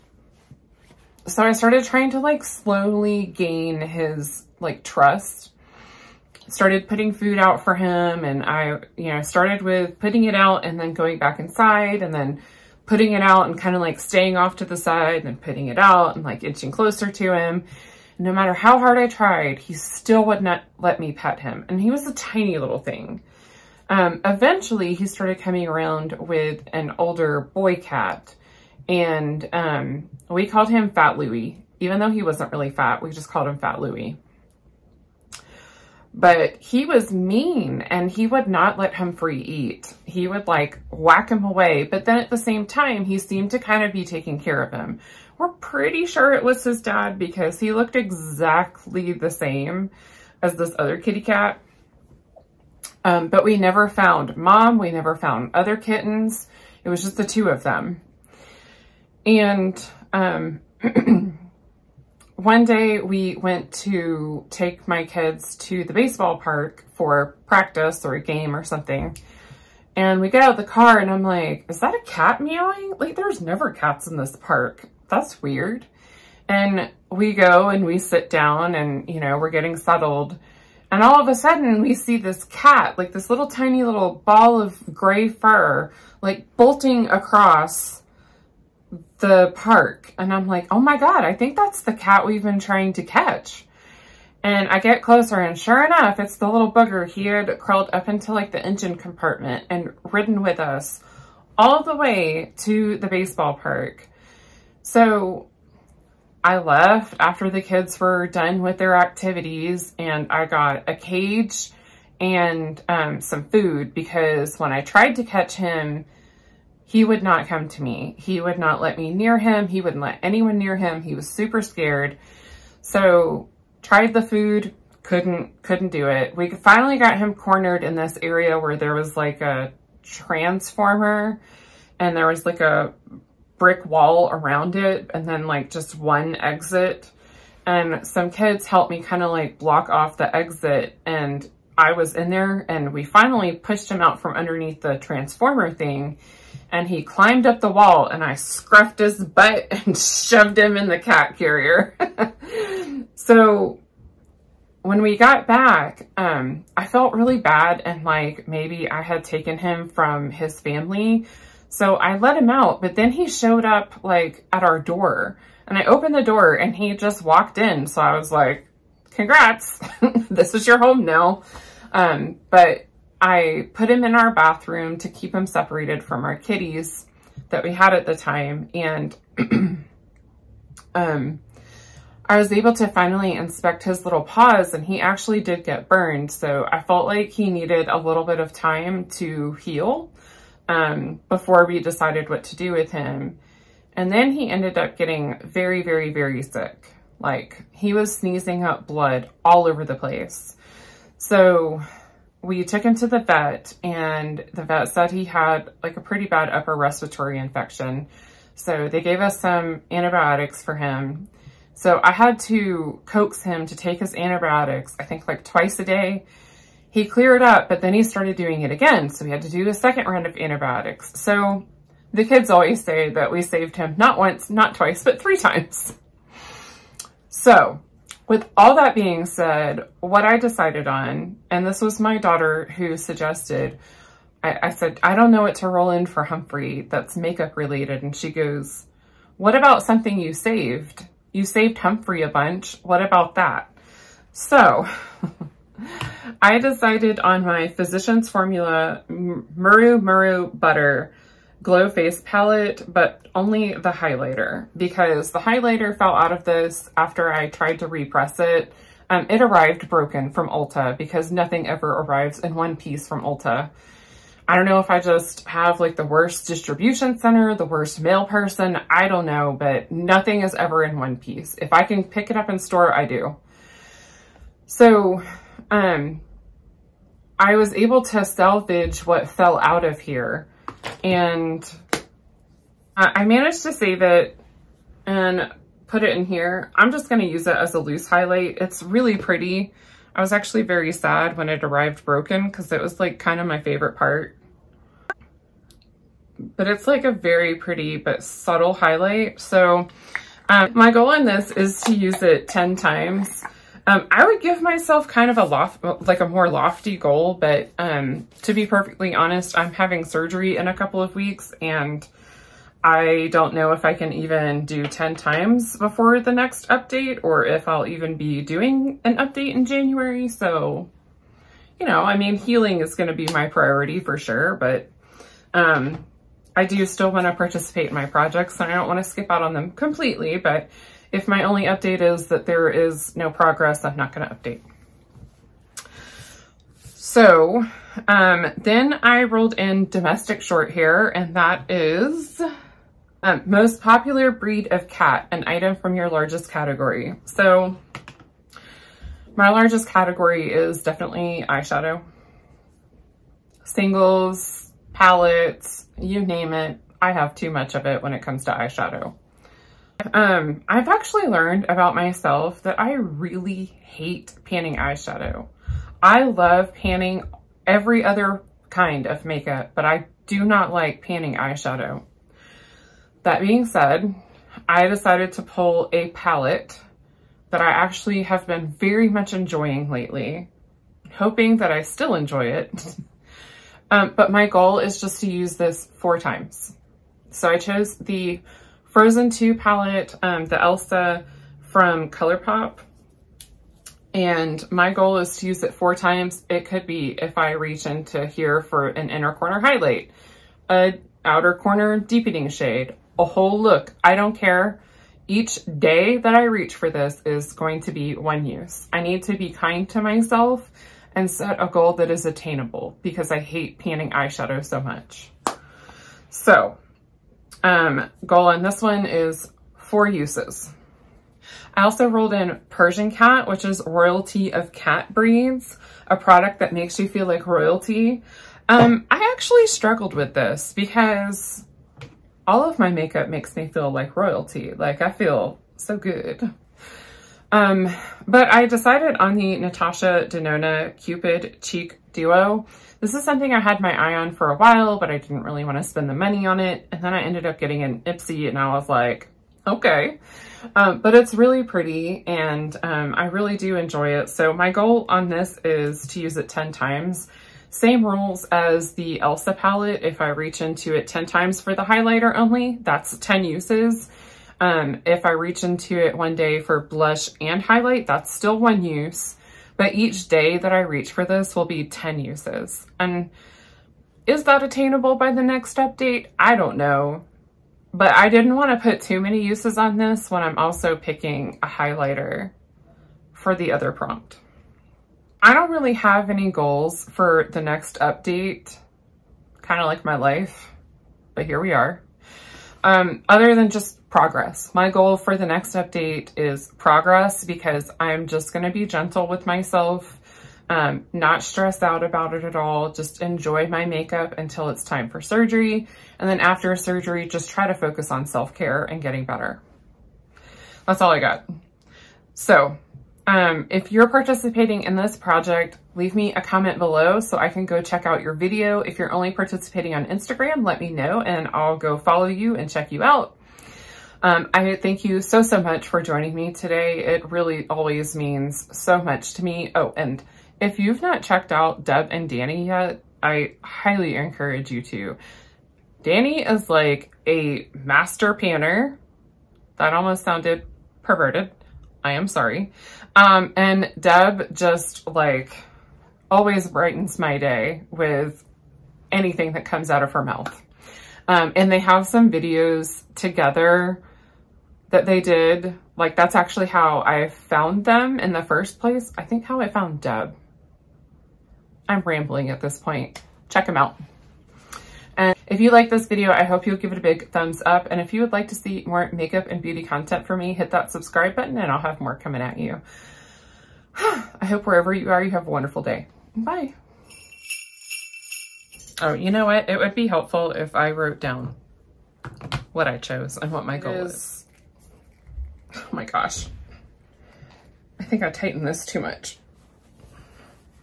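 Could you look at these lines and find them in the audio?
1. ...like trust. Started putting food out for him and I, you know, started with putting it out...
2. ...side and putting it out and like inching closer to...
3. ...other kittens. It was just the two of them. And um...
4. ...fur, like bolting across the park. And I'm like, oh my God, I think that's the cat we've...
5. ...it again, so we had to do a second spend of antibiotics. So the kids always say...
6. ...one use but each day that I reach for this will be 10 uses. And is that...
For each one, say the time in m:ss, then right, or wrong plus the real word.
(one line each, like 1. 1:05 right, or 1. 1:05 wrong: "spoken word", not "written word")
1. 0:04 right
2. 0:14 right
3. 0:55 right
4. 1:25 right
5. 3:38 wrong: "round", not "spend"
6. 7:48 right.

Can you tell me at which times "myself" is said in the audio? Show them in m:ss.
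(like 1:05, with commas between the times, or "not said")
5:04, 6:01, 6:50, 8:19.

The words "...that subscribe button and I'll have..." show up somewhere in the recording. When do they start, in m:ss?
9:30.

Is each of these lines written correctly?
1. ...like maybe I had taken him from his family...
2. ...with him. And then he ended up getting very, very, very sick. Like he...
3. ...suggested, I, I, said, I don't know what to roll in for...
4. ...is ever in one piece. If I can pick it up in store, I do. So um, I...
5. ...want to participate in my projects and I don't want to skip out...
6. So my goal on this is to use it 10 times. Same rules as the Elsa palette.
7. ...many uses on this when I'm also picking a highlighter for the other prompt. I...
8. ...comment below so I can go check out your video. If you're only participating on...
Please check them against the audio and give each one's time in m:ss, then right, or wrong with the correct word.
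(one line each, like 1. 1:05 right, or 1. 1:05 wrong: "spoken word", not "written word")
1. 2:38 right
2. 3:12 right
3. 3:52 right
4. 4:30 right
5. 5:27 right
6. 7:34 right
7. 7:59 right
8. 8:36 right.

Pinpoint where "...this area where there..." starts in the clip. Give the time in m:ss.
2:07.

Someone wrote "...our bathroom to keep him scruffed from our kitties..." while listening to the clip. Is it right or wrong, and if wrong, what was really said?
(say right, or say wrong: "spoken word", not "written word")
wrong: "separated", not "scruffed".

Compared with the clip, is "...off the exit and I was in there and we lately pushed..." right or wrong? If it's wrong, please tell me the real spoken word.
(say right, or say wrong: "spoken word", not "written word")
wrong: "finally", not "lately".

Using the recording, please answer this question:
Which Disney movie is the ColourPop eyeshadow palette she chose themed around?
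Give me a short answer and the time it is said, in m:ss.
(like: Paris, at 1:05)
Frozen 2, at 6:28.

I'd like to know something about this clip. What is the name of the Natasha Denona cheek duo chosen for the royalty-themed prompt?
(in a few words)
Cupid.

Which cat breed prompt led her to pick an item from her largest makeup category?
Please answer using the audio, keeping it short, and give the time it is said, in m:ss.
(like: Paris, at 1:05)
domestic short hair, at 5:39.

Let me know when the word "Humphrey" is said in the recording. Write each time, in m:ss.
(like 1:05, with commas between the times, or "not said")
0:38, 3:56, 4:01.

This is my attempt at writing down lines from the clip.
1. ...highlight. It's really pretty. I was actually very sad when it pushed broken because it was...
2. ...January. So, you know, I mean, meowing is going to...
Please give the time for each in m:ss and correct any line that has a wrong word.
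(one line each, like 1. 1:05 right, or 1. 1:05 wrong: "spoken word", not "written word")
1. 4:48 wrong: "arrived", not "pushed"
2. 5:19 wrong: "healing", not "meowing".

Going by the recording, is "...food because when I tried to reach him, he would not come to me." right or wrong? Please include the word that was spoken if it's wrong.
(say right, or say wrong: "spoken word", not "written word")
wrong: "catch", not "reach".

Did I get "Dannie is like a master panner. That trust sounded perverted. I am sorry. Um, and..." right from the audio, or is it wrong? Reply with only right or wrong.
wrong.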